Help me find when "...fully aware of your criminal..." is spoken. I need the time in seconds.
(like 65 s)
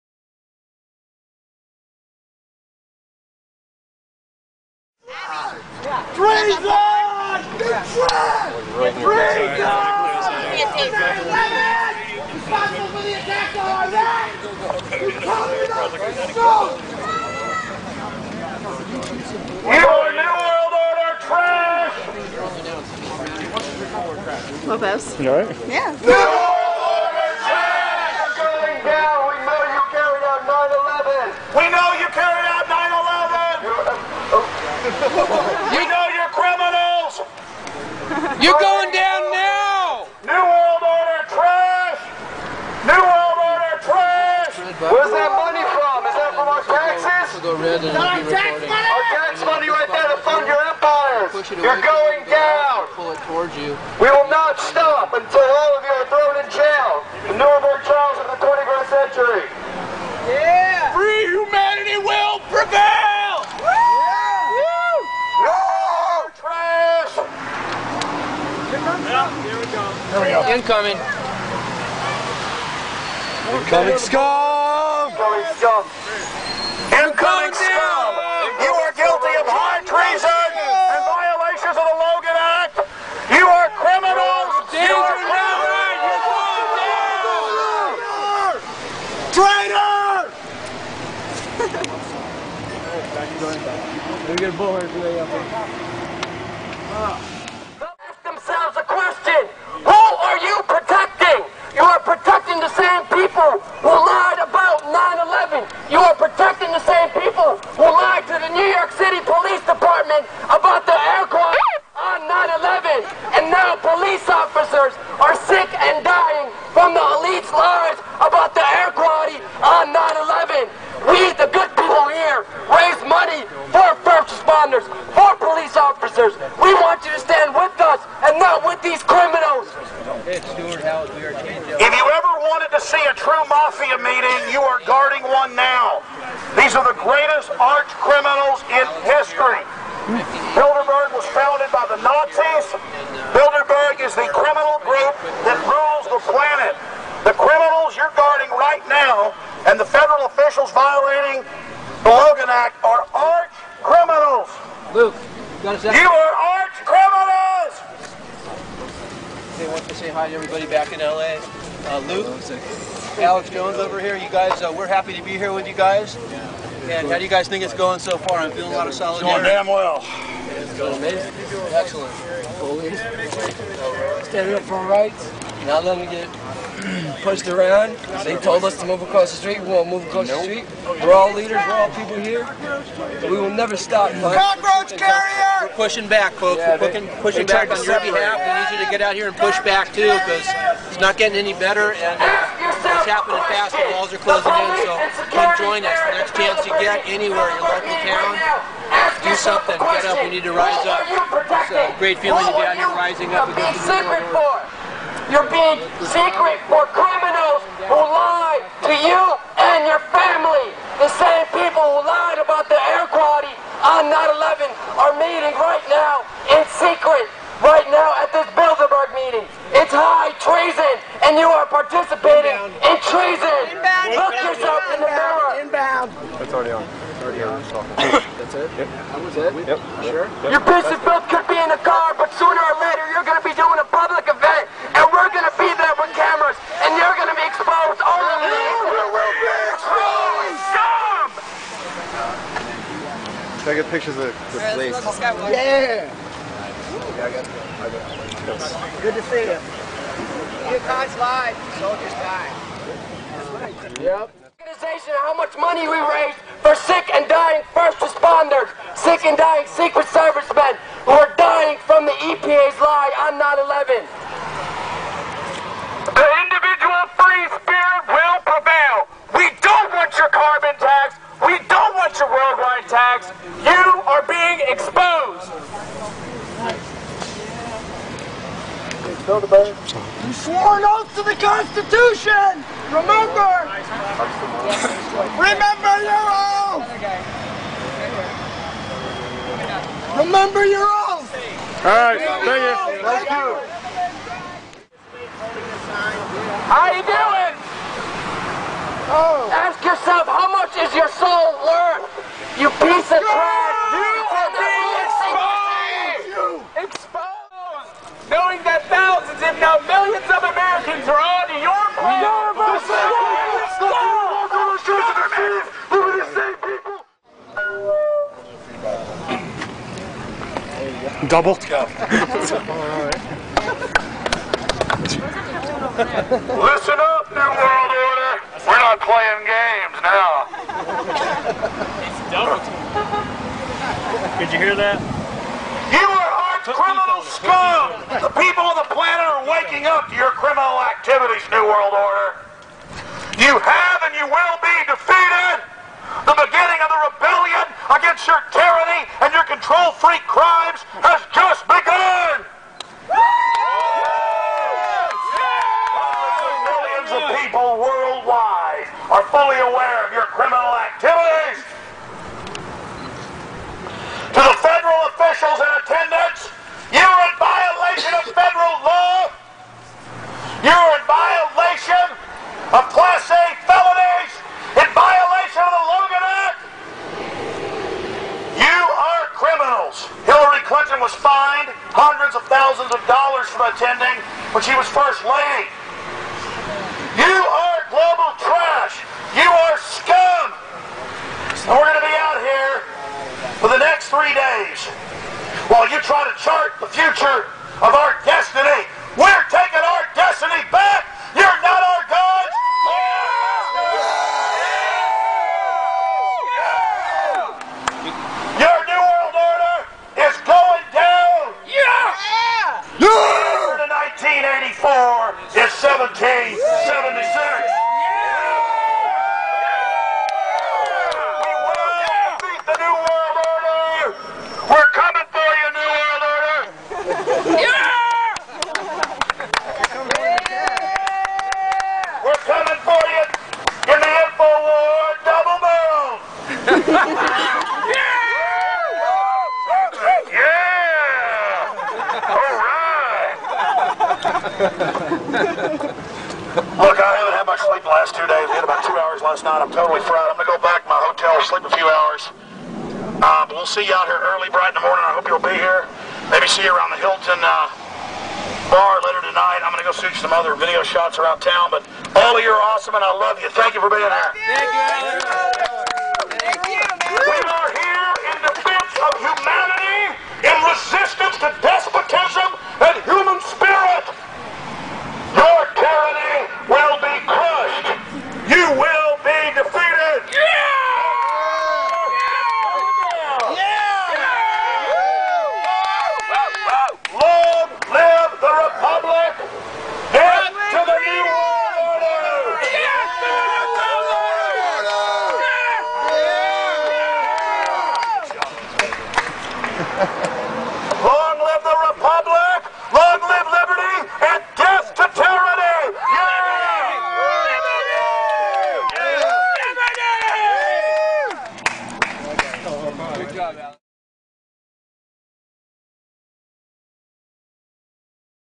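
359 s.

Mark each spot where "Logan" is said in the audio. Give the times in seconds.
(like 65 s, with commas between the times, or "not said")
152 s, 375 s.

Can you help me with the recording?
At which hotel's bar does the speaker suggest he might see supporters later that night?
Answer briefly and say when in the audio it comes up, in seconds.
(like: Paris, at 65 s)
Hilton, at 457 s.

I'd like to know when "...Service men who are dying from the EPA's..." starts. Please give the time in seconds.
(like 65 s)
260 s.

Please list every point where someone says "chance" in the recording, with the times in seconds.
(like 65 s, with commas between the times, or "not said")
196 s.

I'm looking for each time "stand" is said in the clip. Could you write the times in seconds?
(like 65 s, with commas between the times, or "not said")
127 s, 174 s.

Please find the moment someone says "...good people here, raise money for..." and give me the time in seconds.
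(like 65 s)
121 s.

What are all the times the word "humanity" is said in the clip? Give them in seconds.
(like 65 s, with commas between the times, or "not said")
61 s, 469 s.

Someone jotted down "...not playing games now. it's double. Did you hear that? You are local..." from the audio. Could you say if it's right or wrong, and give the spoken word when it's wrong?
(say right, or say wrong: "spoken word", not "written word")
wrong: "criminal", not "local".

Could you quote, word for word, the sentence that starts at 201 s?
It's a great feeling to be out here rising up against the world.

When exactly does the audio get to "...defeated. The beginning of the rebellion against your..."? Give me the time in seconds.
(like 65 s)
344 s.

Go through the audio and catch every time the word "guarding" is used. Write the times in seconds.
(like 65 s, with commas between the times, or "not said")
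134 s, 148 s.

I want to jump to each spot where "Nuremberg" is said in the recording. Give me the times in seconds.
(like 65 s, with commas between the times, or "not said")
57 s.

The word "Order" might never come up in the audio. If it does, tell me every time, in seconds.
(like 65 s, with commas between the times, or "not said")
20 s, 327 s, 341 s.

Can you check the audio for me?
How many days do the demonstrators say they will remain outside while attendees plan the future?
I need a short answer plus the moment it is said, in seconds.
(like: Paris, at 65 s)
3, at 394 s.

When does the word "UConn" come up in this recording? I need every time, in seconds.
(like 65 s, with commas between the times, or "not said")
250 s.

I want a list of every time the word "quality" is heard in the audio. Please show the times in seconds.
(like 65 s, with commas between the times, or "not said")
111 s, 118 s, 213 s.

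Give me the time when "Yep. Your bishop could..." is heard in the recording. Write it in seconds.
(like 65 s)
230 s.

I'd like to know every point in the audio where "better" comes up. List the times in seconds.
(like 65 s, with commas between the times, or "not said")
191 s.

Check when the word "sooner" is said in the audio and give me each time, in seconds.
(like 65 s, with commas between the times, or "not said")
232 s.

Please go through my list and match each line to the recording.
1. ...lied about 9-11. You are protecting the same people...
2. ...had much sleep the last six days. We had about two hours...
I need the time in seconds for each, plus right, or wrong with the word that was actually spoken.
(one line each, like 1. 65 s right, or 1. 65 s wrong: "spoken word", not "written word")
1. 103 s right
2. 447 s wrong: "two", not "six".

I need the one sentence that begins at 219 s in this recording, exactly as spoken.
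It's high treason, and you are participating Inbound.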